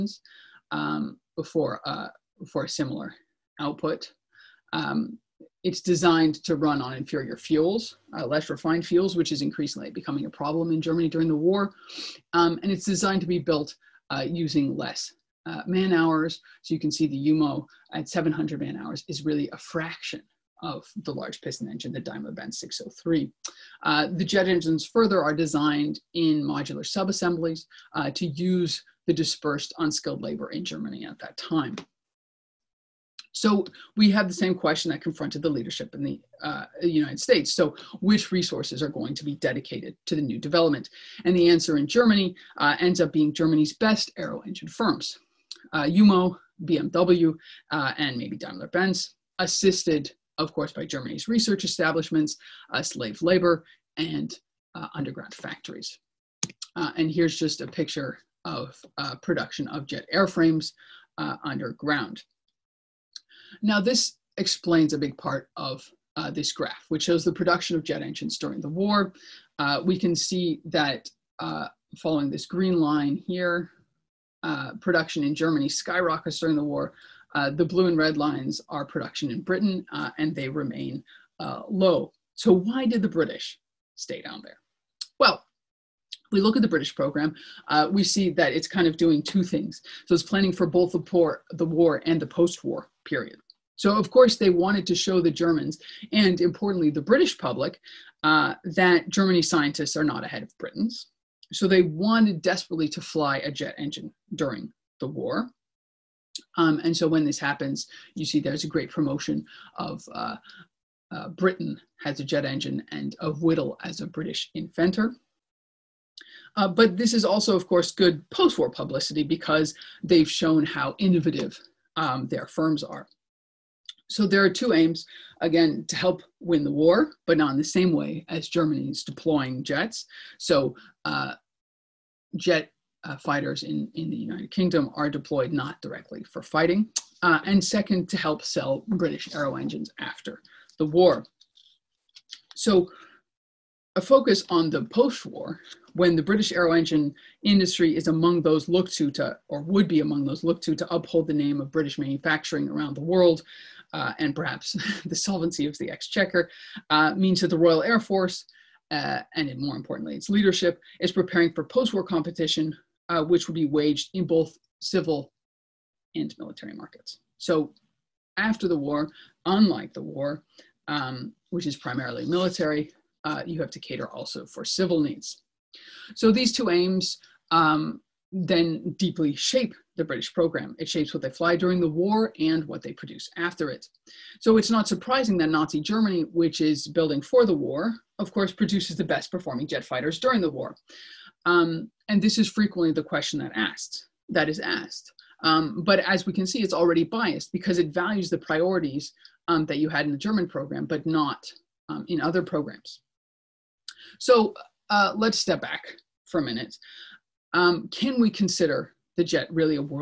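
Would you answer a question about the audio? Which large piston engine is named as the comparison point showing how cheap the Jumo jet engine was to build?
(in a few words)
Daimler Benz 603.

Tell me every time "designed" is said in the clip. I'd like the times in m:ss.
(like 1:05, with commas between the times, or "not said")
0:05, 0:12, 0:25.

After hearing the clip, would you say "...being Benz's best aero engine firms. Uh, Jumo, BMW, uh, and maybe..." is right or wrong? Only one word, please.
wrong.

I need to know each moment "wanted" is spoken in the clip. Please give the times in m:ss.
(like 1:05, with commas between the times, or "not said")
1:34, 1:41.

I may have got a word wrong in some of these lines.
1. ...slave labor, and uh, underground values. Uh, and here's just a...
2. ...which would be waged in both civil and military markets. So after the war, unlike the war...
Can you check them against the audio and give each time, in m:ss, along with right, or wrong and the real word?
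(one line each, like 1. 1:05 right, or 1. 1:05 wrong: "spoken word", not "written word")
1. 0:52 wrong: "factories", not "values"
2. 2:43 right.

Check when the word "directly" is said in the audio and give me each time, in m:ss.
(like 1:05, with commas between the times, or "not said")
2:15.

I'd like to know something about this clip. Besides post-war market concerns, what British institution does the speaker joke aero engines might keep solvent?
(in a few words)
the exchequer.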